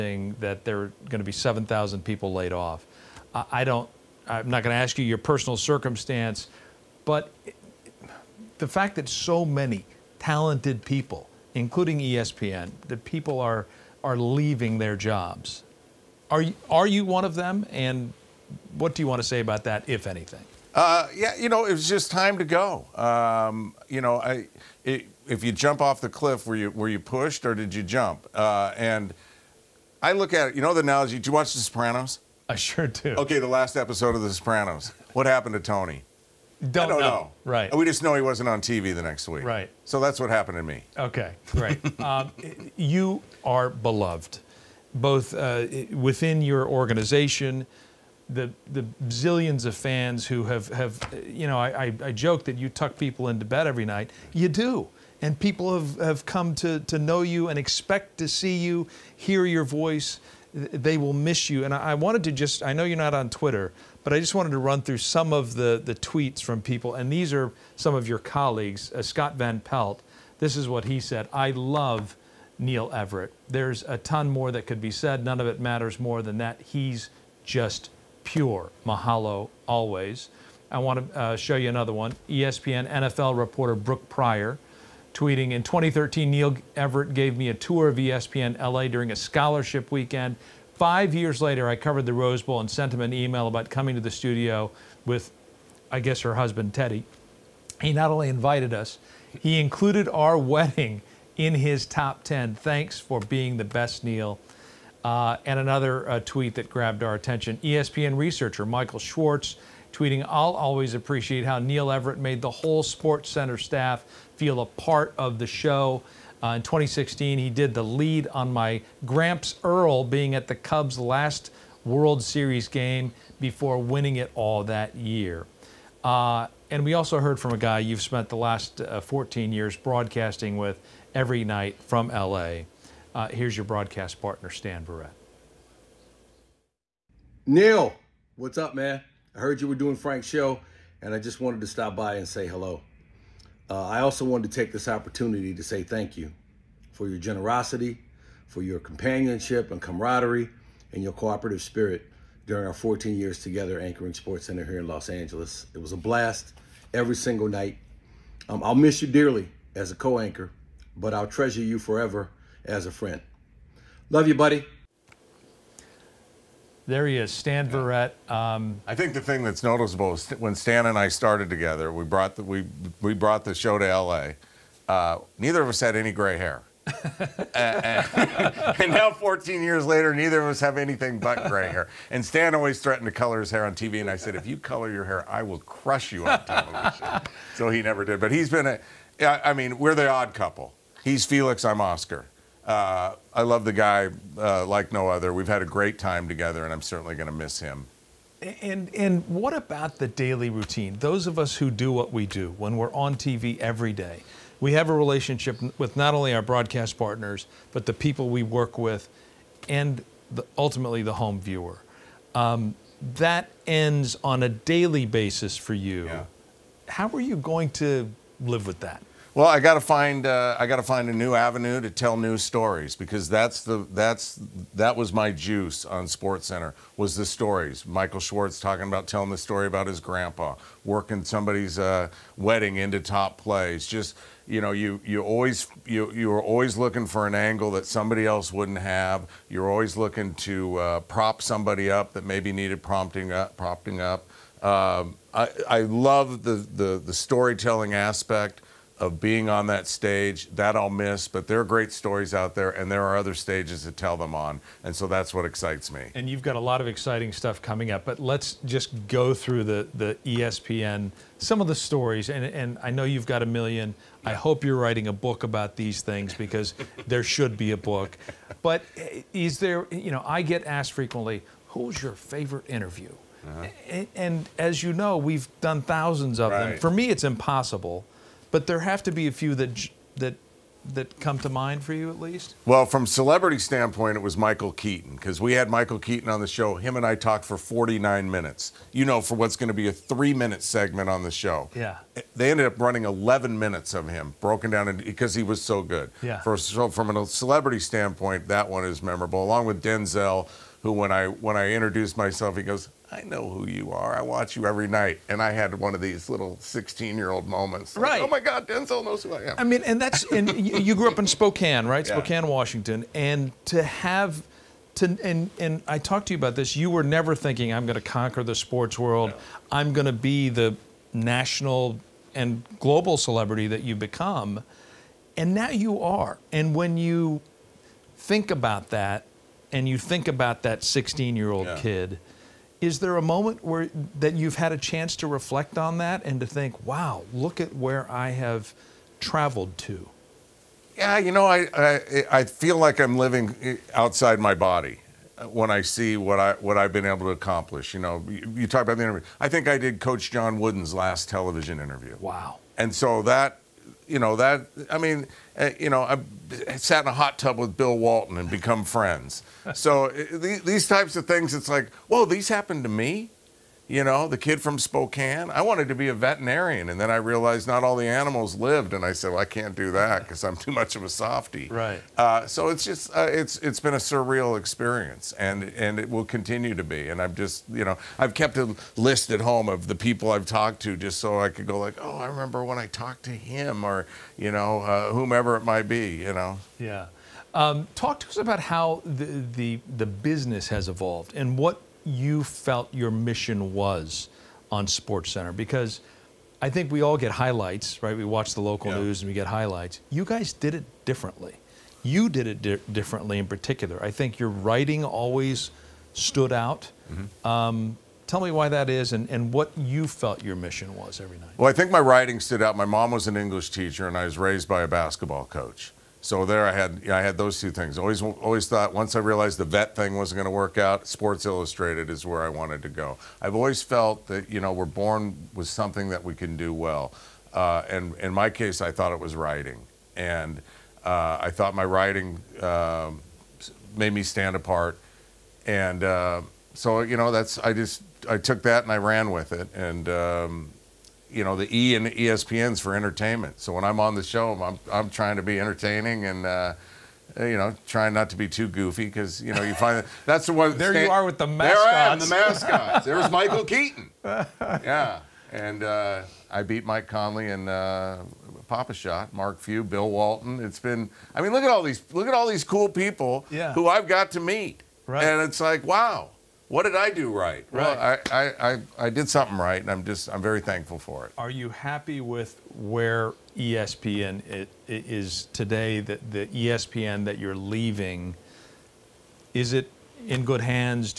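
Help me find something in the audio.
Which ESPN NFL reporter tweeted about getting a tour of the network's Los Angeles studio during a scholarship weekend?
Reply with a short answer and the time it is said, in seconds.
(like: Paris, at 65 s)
Brooke Pryor, at 83 s.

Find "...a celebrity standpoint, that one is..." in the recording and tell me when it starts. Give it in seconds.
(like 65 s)
297 s.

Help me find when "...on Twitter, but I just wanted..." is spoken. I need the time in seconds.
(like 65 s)
63 s.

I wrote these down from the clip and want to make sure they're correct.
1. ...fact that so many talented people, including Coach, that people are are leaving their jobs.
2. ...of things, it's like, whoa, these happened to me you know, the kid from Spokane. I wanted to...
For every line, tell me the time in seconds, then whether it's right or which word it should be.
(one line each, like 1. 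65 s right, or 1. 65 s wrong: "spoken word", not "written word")
1. 8 s wrong: "ESPN", not "Coach"
2. 361 s right.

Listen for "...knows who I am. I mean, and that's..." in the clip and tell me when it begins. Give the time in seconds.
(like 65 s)
309 s.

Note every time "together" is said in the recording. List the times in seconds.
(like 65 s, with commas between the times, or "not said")
153 s, 171 s, 196 s.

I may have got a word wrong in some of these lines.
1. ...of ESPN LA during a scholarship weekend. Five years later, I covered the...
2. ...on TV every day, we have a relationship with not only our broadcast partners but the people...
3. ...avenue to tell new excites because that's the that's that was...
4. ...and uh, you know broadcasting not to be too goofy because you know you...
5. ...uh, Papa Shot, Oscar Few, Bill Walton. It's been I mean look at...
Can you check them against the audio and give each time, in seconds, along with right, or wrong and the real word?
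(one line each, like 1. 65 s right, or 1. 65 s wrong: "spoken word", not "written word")
1. 87 s right
2. 202 s right
3. 221 s wrong: "stories", not "excites"
4. 446 s wrong: "trying", not "broadcasting"
5. 457 s wrong: "Mark", not "Oscar".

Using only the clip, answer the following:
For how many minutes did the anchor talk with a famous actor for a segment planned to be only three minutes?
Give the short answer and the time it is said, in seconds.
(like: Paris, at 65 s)
49, at 287 s.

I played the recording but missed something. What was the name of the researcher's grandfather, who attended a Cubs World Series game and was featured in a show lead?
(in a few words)
Earl.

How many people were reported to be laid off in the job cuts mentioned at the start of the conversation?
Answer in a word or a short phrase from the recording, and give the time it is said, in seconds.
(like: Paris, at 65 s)
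7,000, at 1 s.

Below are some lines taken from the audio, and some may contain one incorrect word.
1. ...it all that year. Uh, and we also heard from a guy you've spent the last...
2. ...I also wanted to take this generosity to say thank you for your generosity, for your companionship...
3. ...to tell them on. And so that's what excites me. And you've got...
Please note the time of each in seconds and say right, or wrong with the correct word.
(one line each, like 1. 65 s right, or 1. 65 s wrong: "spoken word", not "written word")
1. 124 s right
2. 143 s wrong: "opportunity", not "generosity"
3. 253 s right.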